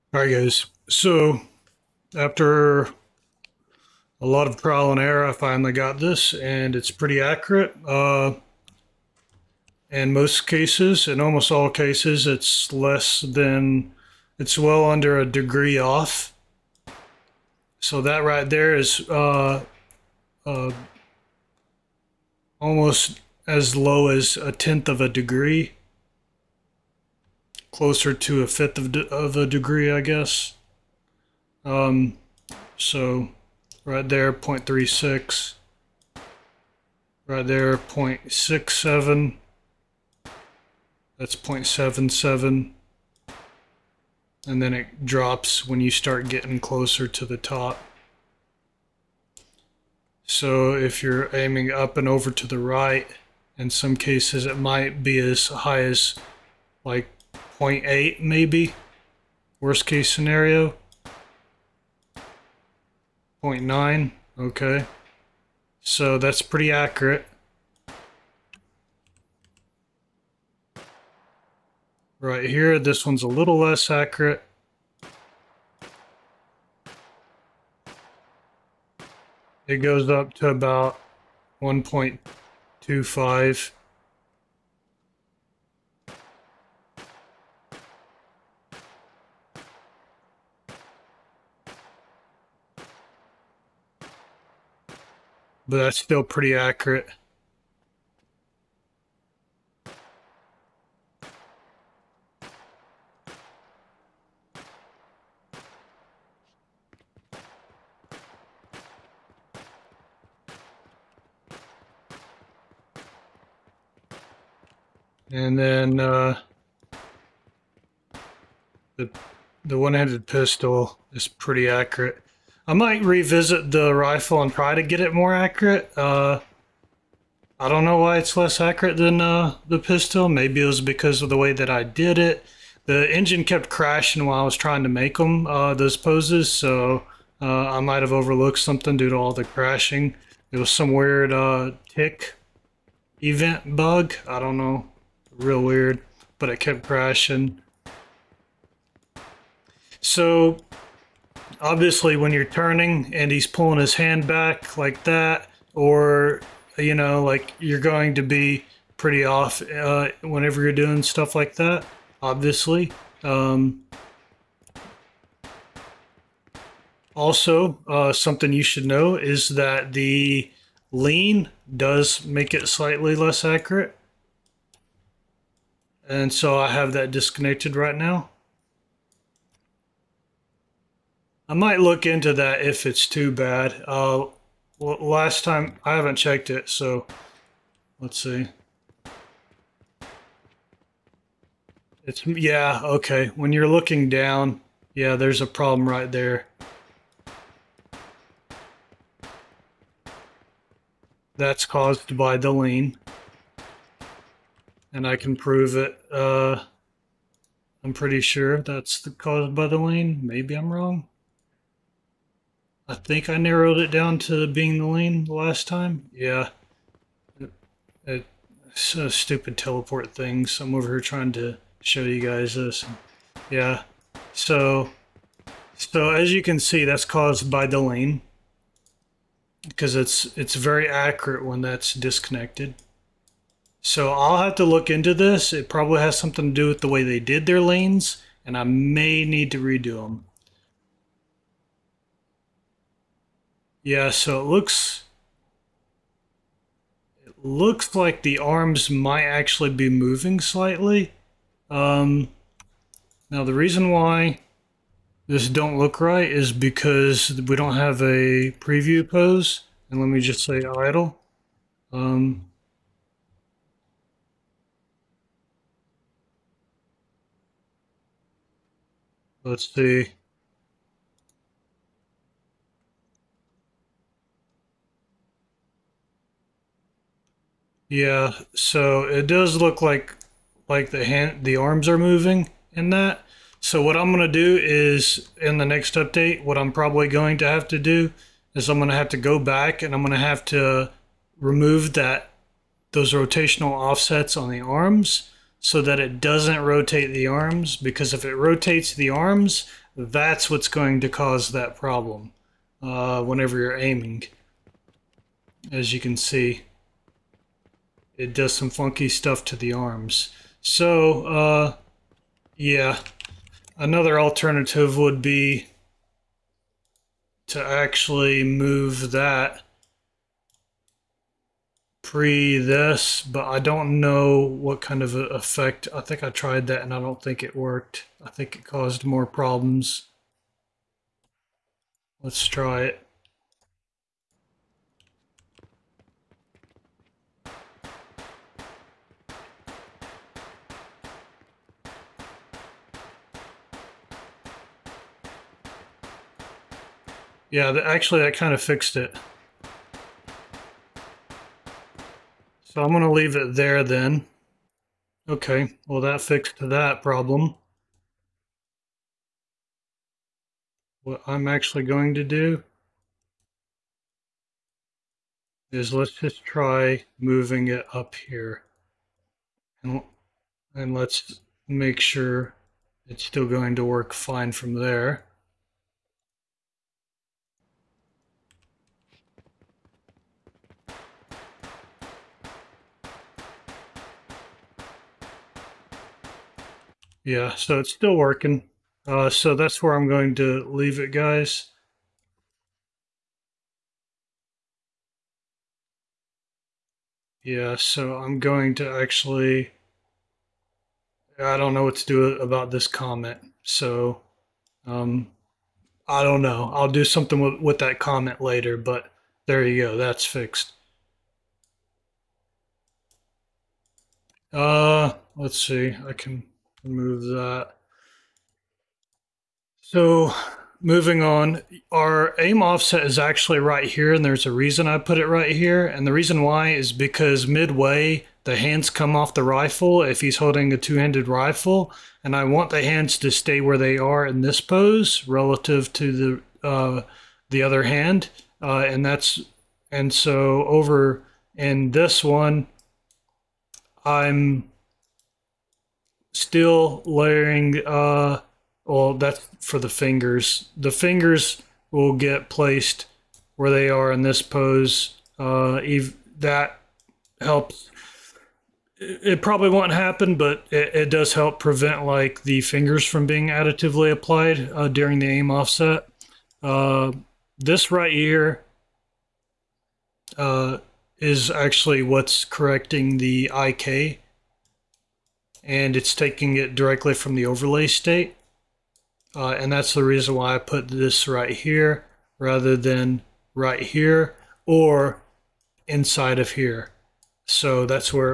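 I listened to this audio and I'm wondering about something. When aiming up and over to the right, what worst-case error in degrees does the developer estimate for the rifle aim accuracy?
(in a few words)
0.8.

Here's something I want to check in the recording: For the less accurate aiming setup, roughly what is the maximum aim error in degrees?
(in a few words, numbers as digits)
1.25.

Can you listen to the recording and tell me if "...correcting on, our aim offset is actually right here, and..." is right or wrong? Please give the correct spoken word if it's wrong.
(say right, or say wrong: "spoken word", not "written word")
wrong: "moving", not "correcting".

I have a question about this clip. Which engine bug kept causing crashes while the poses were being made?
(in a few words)
tick event bug.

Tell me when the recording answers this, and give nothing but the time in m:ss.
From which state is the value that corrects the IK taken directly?
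7:57.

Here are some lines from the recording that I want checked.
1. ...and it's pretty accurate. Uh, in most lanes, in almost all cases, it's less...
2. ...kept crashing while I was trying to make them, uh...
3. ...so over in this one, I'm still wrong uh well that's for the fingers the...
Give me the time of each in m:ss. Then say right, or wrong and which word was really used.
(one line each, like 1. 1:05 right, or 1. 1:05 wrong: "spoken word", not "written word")
1. 0:06 wrong: "cases", not "lanes"
2. 2:13 right
3. 7:20 wrong: "layering", not "wrong".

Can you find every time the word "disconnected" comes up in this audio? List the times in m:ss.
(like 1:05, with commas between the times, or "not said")
2:57, 3:51.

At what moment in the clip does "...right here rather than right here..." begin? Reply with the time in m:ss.
8:01.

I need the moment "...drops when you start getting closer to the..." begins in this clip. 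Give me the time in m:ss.
0:45.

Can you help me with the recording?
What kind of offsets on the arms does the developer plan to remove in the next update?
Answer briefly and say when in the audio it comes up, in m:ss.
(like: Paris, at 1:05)
rotational offsets, at 4:53.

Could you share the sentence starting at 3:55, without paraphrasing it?
It probably has something to do with the way they did their lanes, and I may need to redo them.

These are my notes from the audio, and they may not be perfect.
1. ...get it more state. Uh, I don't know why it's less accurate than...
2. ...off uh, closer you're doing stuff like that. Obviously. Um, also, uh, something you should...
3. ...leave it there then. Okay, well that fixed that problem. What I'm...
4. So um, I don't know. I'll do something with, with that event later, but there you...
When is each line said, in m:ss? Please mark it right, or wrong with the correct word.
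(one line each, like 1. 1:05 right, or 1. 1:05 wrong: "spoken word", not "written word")
1. 2:04 wrong: "accurate", not "state"
2. 2:39 wrong: "whenever", not "closer"
3. 5:53 right
4. 6:43 wrong: "comment", not "event".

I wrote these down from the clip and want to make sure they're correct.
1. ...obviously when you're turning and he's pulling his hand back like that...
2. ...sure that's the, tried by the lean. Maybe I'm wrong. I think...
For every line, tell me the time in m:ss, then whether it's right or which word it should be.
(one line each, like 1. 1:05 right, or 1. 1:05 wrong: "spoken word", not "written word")
1. 2:31 right
2. 3:28 wrong: "caused", not "tried".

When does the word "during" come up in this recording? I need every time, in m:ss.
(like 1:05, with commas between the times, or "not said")
7:44.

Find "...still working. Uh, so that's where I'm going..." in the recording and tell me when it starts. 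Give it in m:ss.
6:27.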